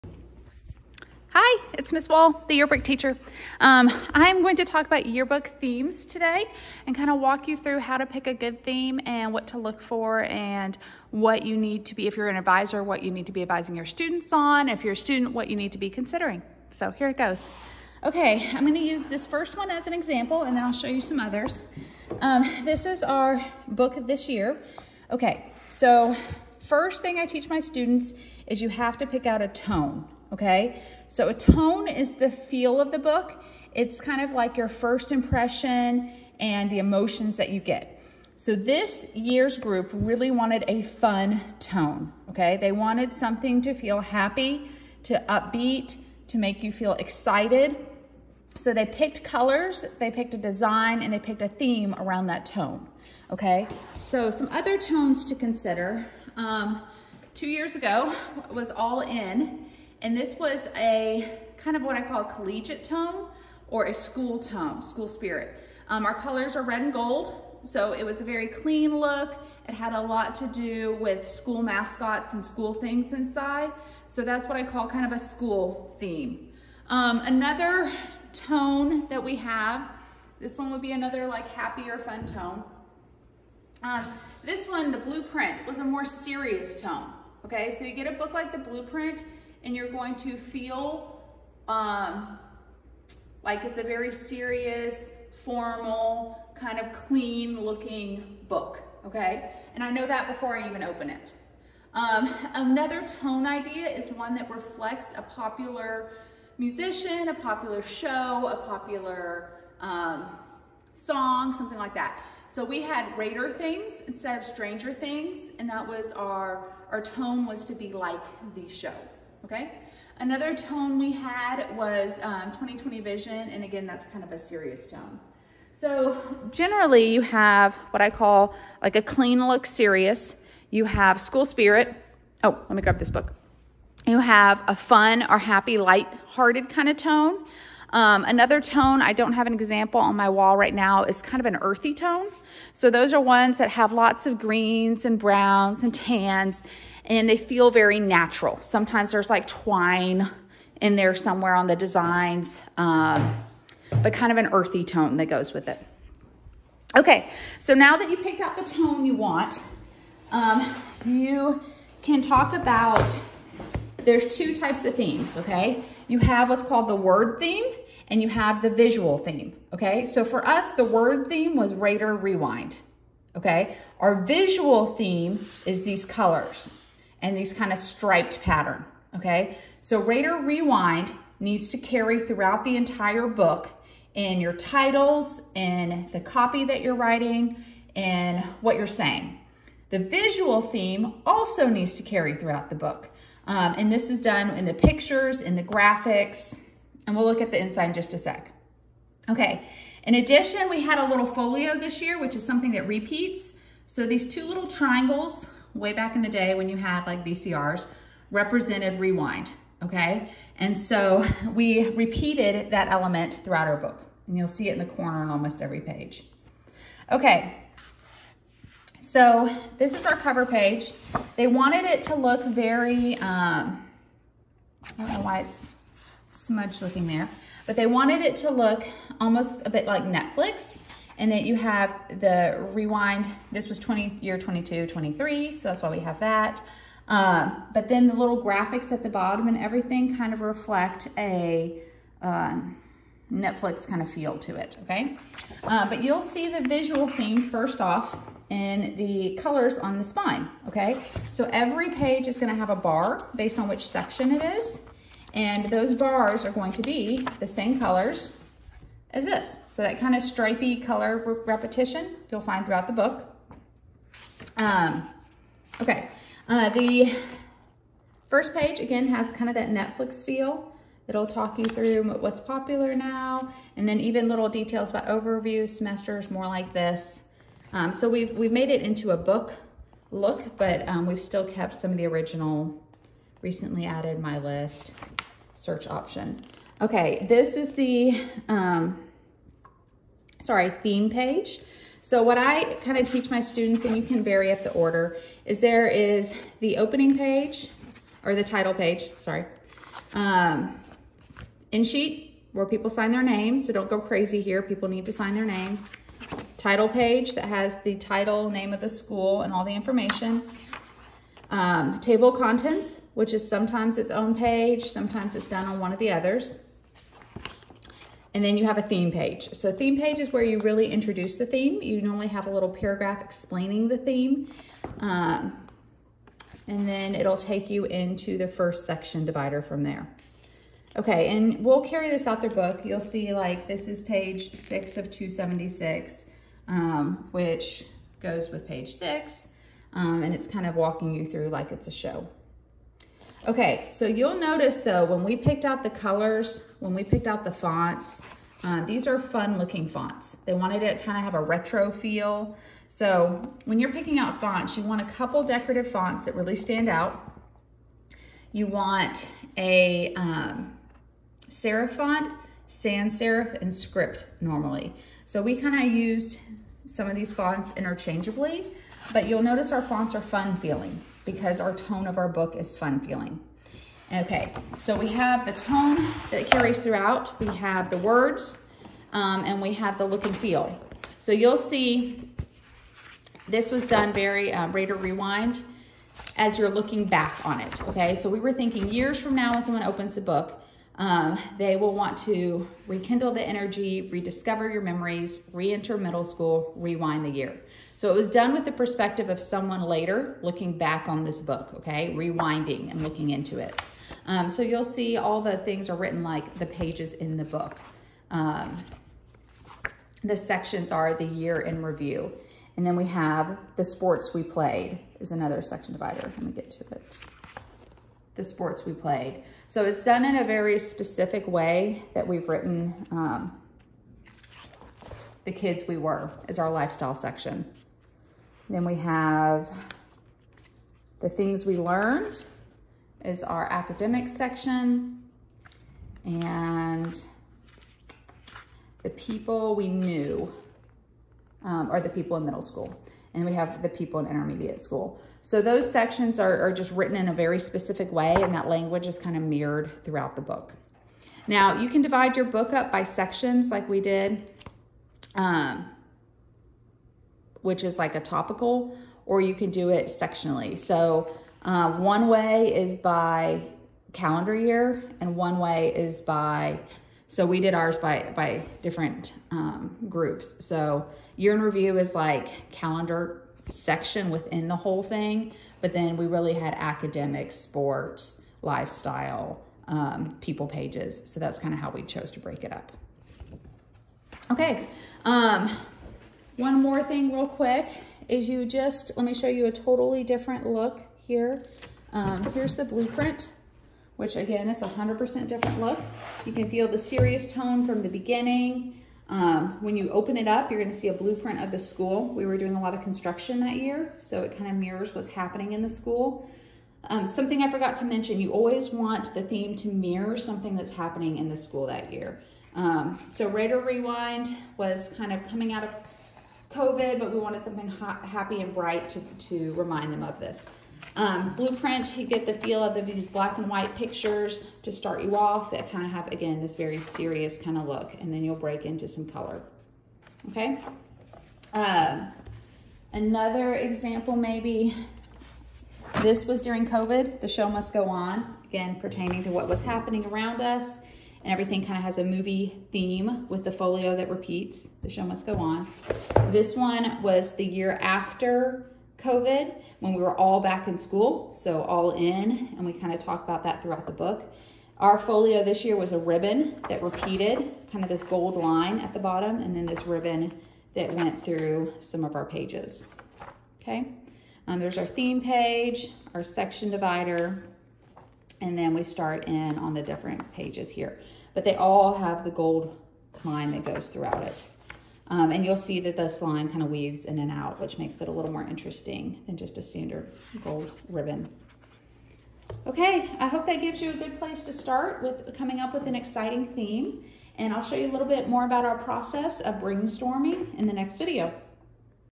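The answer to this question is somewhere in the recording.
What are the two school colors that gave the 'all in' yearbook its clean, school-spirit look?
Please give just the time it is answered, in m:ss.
1:06.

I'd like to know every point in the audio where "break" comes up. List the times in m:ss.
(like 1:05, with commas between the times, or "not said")
8:02, 8:48.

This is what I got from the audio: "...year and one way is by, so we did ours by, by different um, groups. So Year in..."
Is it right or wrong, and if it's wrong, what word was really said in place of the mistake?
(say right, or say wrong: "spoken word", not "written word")
right.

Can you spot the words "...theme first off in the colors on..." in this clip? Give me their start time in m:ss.
4:07.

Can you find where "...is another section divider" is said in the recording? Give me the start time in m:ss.
6:55.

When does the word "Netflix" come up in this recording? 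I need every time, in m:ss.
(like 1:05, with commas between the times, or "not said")
3:50, 4:03, 4:29.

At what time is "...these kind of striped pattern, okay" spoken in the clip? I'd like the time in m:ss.
2:57.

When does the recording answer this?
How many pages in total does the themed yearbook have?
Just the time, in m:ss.
5:35.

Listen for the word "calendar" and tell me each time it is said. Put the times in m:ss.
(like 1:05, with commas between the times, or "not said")
7:44, 7:52.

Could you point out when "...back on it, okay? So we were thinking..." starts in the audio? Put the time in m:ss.
6:27.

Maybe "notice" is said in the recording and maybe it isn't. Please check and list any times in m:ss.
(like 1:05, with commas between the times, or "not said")
5:44, 6:09.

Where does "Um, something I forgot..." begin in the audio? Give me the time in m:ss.
8:27.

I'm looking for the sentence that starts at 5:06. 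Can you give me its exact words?
Title page that has the title, name of the school, and all the information.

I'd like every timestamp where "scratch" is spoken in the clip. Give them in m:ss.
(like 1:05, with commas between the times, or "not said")
not said.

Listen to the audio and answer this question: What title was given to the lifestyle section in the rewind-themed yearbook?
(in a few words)
the kids we were.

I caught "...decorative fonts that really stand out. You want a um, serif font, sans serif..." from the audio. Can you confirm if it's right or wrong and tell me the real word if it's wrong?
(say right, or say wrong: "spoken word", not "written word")
right.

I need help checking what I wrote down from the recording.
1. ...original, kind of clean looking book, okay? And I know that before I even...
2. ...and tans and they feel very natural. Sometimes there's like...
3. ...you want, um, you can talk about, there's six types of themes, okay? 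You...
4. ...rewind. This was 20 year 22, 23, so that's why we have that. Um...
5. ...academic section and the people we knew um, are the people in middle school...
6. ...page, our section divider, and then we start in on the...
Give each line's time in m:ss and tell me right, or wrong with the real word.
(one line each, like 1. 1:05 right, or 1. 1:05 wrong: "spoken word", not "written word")
1. 1:35 wrong: "formal", not "original"
2. 2:25 right
3. 2:39 wrong: "two", not "six"
4. 3:52 right
5. 7:13 right
6. 9:25 right.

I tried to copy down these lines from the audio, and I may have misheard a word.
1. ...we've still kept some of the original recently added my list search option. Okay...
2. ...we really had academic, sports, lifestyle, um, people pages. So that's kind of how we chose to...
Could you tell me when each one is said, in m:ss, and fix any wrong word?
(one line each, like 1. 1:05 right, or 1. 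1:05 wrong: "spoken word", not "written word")
1. 4:41 right
2. 7:56 right.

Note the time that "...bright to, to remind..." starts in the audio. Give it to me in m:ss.
8:38.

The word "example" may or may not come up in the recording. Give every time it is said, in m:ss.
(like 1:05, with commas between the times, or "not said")
0:19, 2:19, 8:53.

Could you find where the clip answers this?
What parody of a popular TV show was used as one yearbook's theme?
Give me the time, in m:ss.
1:53.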